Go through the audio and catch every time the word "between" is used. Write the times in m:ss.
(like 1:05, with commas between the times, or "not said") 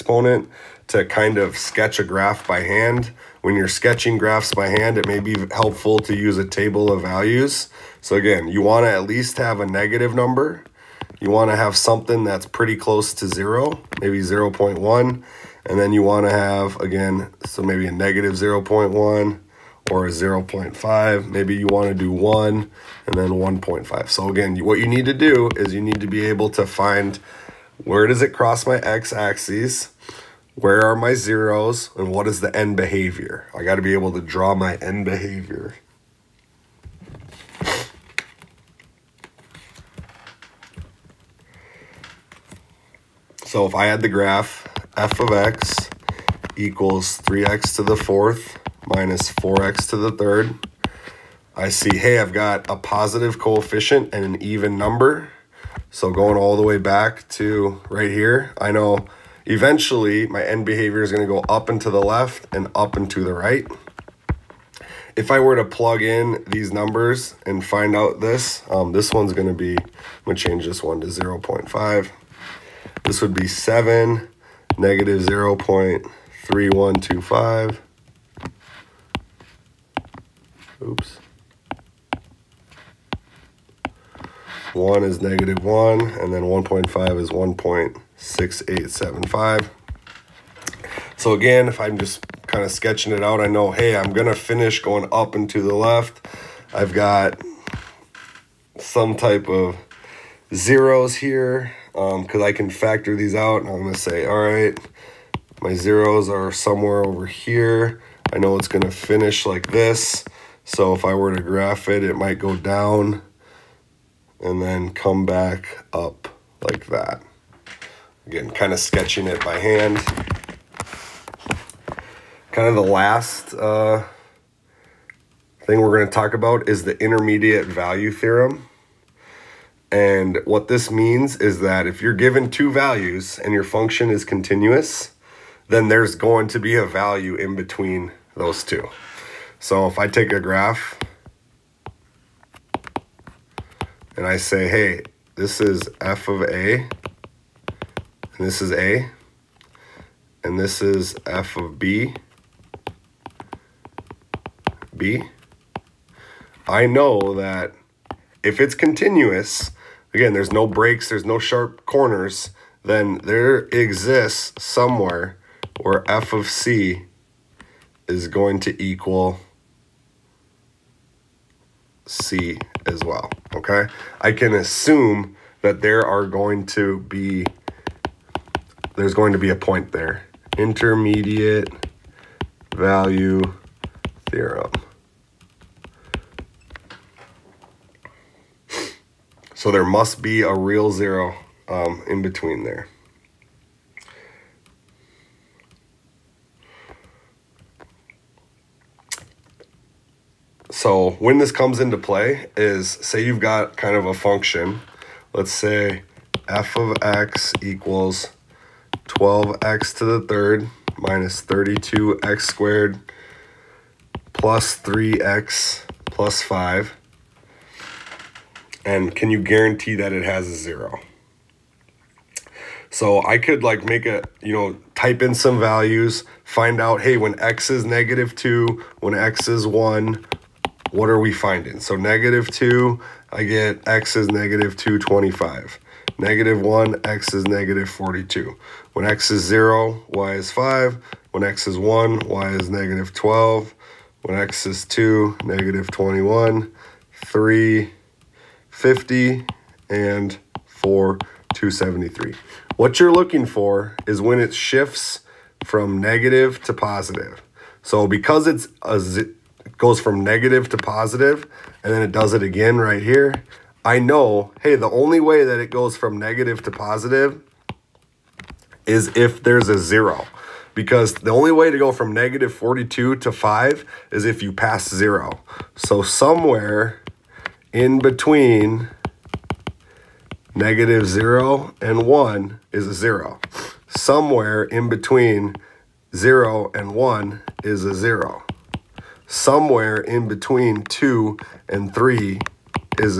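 2:17, 3:12, 4:37, 4:44, 4:50.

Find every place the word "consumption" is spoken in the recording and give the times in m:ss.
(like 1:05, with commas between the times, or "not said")
not said.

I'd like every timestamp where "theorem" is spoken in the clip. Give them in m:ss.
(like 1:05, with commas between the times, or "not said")
2:08, 3:04.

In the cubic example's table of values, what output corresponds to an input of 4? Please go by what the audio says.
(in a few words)
273.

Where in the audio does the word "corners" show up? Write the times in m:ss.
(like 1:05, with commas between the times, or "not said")
2:41.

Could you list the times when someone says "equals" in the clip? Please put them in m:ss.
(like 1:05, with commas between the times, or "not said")
0:46, 2:48, 3:27.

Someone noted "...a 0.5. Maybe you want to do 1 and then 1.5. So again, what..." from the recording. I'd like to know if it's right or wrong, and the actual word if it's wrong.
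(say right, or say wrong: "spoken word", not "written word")
right.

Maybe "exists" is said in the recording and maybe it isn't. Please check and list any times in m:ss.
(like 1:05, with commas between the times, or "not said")
2:43.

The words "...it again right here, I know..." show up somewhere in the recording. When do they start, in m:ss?
4:22.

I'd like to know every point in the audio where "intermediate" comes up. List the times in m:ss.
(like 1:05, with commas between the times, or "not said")
2:06, 3:00.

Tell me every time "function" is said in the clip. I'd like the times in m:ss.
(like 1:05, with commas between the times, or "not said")
2:13, 3:24.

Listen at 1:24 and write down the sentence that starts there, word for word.
One is negative one, and then 1.5 is 1.6875.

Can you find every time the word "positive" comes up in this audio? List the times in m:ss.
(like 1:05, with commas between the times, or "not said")
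0:52, 4:16, 4:20, 4:26.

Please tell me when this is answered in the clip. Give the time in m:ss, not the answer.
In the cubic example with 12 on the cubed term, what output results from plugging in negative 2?
3:54.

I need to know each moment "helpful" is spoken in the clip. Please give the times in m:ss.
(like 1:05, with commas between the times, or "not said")
0:05.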